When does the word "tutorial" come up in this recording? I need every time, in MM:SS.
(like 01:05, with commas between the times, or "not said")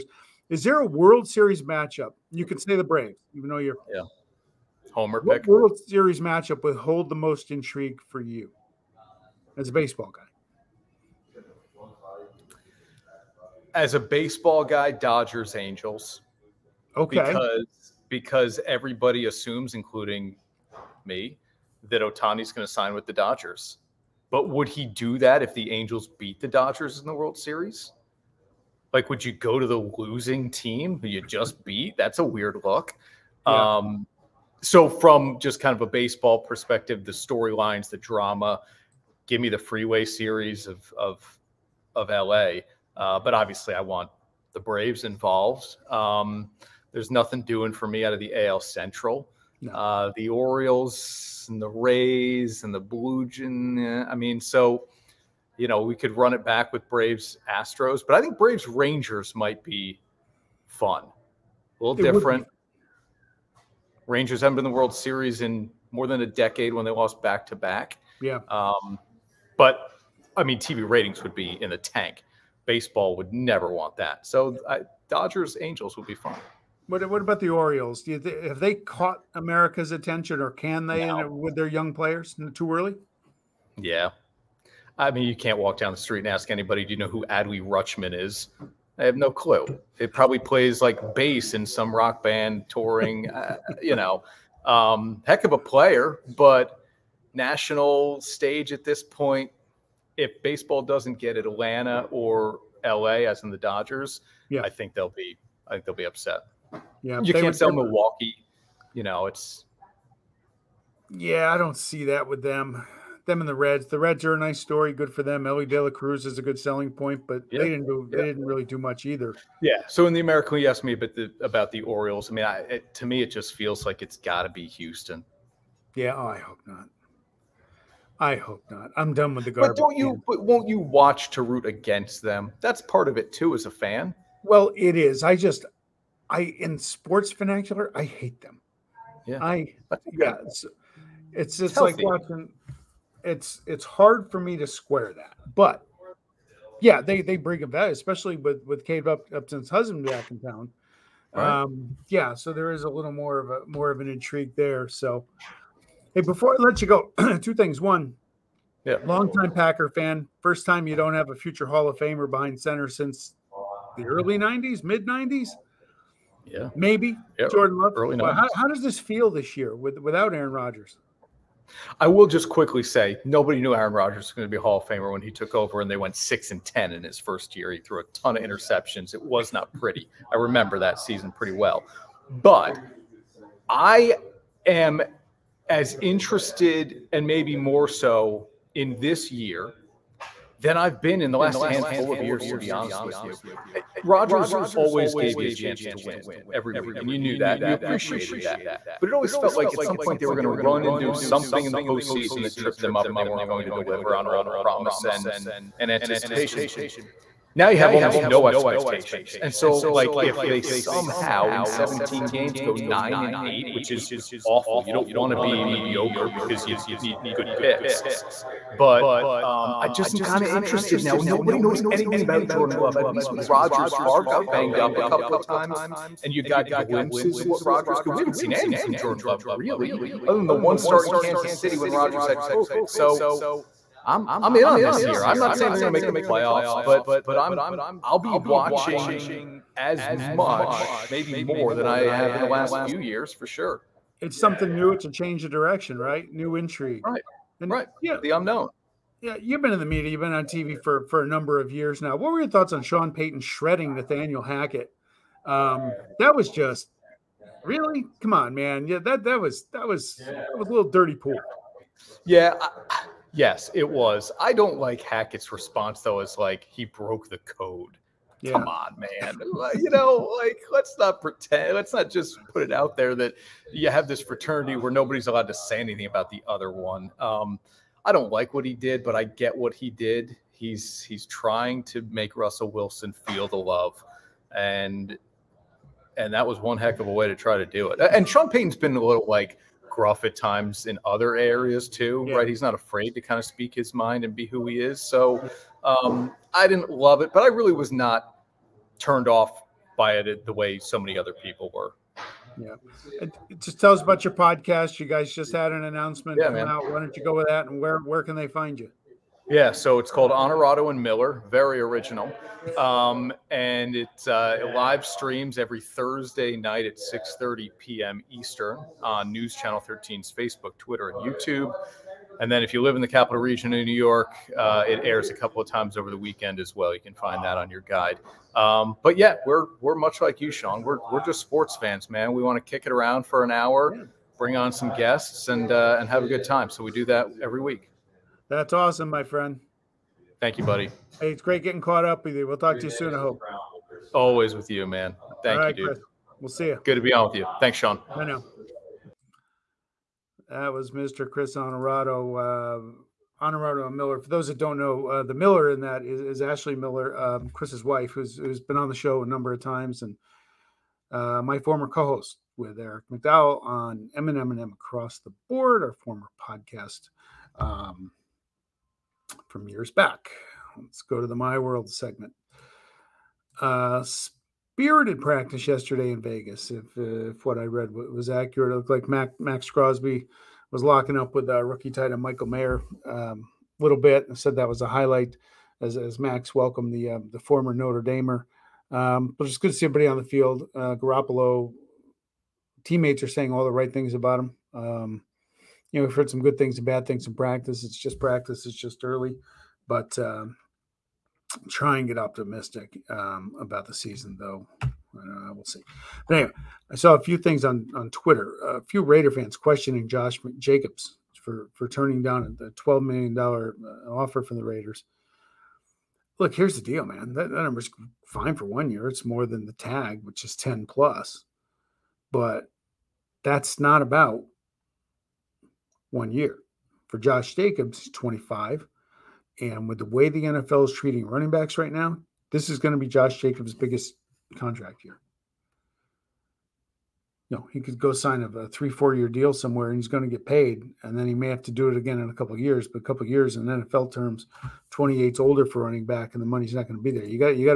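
not said.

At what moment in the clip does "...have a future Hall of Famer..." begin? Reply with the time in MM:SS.
02:41.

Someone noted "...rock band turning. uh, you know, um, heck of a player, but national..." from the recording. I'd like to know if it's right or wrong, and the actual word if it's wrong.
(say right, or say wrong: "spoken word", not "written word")
wrong: "touring", not "turning".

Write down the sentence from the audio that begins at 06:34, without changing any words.
Um, you know, we've heard some good things and bad things in practice.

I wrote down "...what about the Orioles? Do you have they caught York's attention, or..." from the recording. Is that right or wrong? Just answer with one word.
wrong.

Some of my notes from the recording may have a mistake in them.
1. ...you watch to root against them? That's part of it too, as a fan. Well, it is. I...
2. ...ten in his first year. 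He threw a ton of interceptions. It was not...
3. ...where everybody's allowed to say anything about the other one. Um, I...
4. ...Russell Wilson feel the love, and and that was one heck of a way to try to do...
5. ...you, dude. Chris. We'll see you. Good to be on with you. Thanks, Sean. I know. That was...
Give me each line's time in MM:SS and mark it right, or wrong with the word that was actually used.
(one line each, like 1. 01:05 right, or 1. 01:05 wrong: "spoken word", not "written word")
1. 02:10 right
2. 02:56 right
3. 04:34 wrong: "nobody", not "everybody"
4. 04:42 right
5. 05:45 right.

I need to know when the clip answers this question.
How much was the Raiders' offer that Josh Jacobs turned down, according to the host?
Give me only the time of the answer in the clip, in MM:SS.
06:52.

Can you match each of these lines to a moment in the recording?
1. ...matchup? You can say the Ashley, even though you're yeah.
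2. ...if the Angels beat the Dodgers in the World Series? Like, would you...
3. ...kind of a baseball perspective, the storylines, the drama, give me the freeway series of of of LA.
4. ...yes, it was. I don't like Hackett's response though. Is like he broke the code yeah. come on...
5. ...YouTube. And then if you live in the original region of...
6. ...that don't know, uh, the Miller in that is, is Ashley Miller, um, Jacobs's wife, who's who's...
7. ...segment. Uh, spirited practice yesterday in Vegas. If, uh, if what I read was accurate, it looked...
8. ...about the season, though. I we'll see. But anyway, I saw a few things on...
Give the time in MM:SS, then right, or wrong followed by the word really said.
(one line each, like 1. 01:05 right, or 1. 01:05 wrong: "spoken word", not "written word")
1. 00:01 wrong: "Braves", not "Ashley"
2. 00:25 right
3. 00:35 right
4. 04:23 right
5. 05:21 wrong: "capital", not "original"
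6. 05:54 wrong: "Chris", not "Jacobs"
7. 06:11 right
8. 06:43 right.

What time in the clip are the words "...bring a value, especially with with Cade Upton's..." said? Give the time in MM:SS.
02:27.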